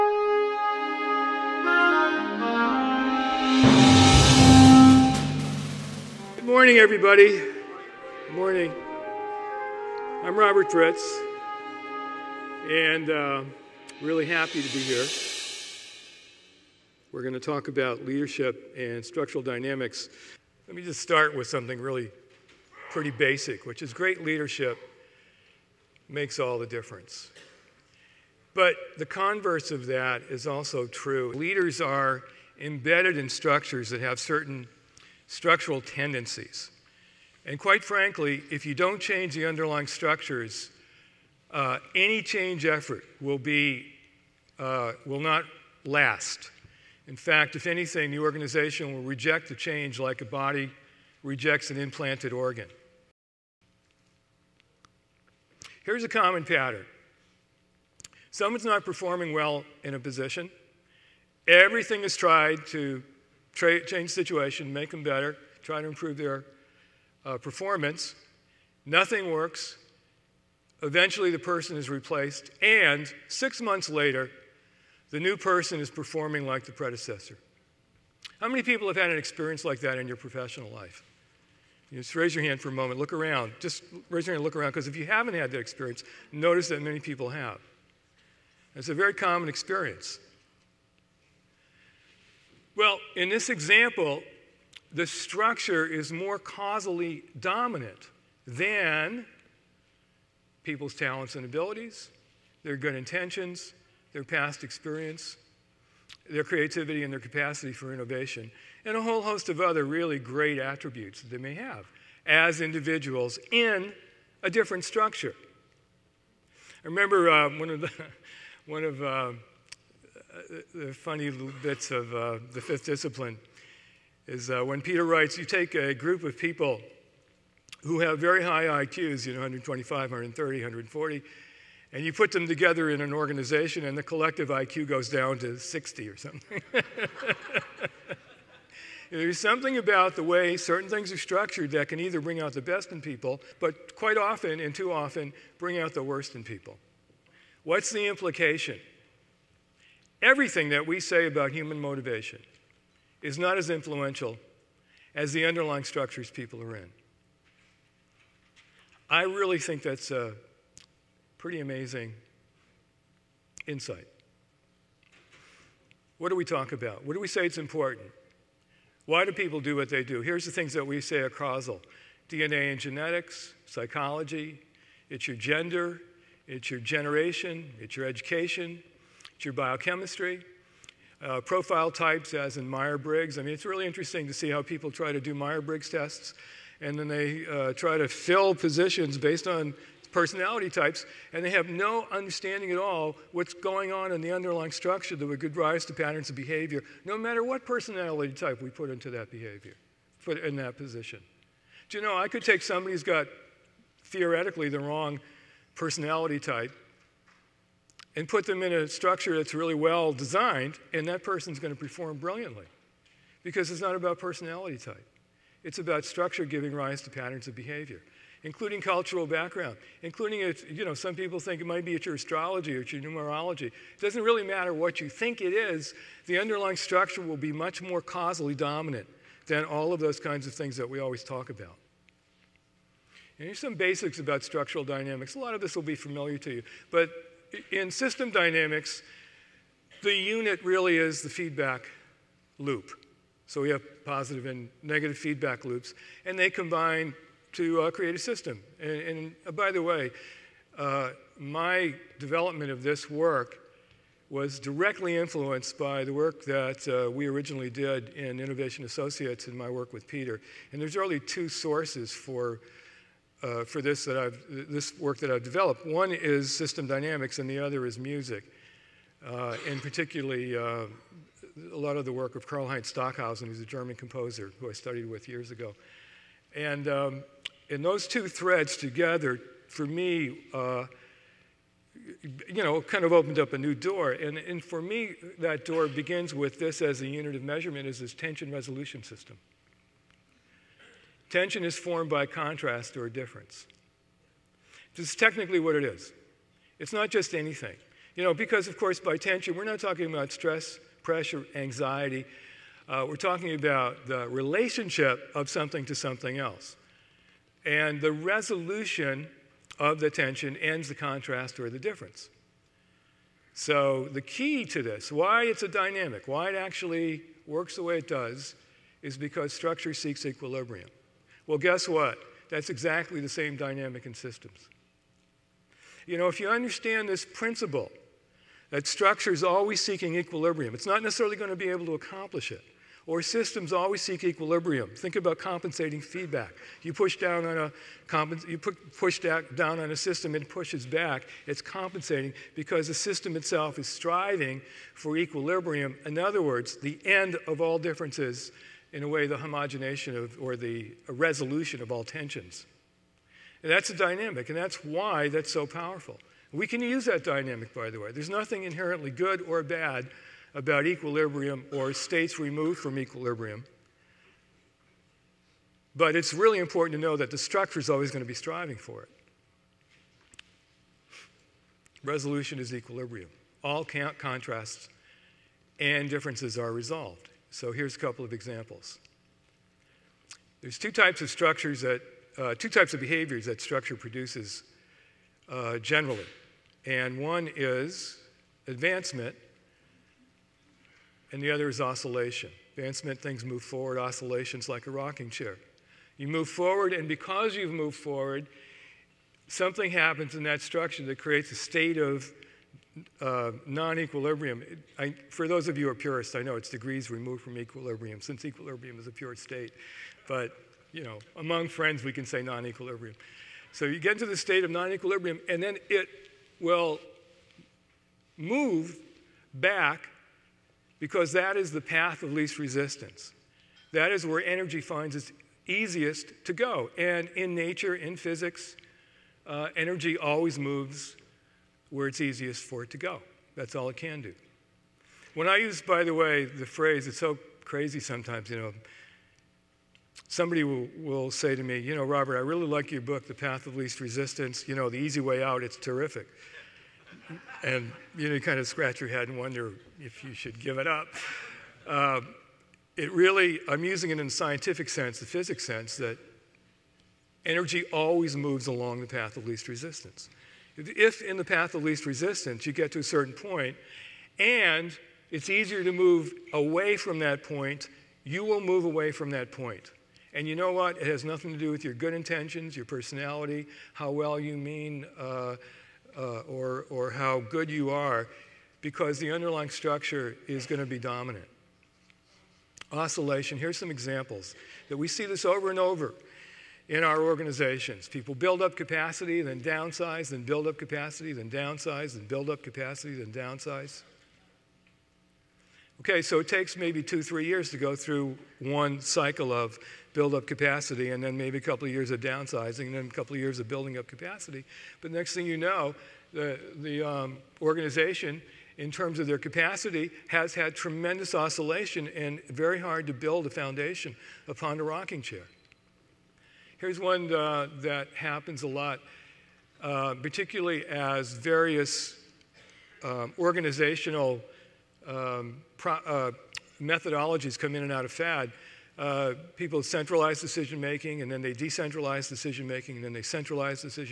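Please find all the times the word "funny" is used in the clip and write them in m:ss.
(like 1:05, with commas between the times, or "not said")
2:00.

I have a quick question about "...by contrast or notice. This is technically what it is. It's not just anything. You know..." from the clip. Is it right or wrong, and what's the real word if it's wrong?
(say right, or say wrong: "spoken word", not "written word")
wrong: "difference", not "notice".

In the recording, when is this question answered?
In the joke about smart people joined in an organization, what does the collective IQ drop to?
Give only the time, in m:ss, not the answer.
2:15.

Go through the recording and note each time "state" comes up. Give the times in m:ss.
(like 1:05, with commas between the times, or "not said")
6:01, 6:41, 6:49, 6:54.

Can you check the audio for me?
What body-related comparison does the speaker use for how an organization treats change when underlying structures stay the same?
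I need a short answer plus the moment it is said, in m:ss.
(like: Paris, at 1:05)
implanted organ, at 0:51.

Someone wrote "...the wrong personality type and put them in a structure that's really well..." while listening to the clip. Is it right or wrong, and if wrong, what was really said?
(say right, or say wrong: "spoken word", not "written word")
right.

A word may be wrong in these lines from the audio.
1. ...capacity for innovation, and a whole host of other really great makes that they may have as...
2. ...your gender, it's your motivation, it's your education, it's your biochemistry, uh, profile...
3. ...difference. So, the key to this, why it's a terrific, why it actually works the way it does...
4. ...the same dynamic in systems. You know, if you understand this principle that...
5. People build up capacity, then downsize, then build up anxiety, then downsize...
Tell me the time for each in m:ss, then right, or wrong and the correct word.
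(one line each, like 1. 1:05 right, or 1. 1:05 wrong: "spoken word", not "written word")
1. 1:47 wrong: "attributes", not "makes"
2. 2:55 wrong: "generation", not "motivation"
3. 5:11 wrong: "dynamic", not "terrific"
4. 5:23 right
5. 8:08 wrong: "capacity", not "anxiety".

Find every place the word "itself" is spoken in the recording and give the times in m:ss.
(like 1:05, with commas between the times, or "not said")
5:43.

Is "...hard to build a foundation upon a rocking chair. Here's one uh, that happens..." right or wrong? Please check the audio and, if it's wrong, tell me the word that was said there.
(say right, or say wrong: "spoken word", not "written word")
right.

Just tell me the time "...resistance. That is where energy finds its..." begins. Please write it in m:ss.
7:02.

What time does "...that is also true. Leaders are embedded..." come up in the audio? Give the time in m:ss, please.
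0:29.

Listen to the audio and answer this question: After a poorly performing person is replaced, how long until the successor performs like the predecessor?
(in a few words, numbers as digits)
6 months.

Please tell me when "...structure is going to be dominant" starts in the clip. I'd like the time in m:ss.
7:59.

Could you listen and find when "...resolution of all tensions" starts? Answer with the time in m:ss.
5:51.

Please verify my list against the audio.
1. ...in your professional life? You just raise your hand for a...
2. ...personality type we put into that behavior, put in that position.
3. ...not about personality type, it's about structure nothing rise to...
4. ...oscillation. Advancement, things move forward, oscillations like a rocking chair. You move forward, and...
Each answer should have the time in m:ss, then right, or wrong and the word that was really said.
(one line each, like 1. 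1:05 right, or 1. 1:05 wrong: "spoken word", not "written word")
1. 1:19 right
2. 3:17 right
3. 3:33 wrong: "giving", not "nothing"
4. 6:31 right.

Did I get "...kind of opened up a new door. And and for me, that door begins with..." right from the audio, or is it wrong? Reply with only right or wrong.
right.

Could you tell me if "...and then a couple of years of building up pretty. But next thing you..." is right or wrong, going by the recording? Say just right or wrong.
wrong.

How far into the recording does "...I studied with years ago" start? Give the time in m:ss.
4:34.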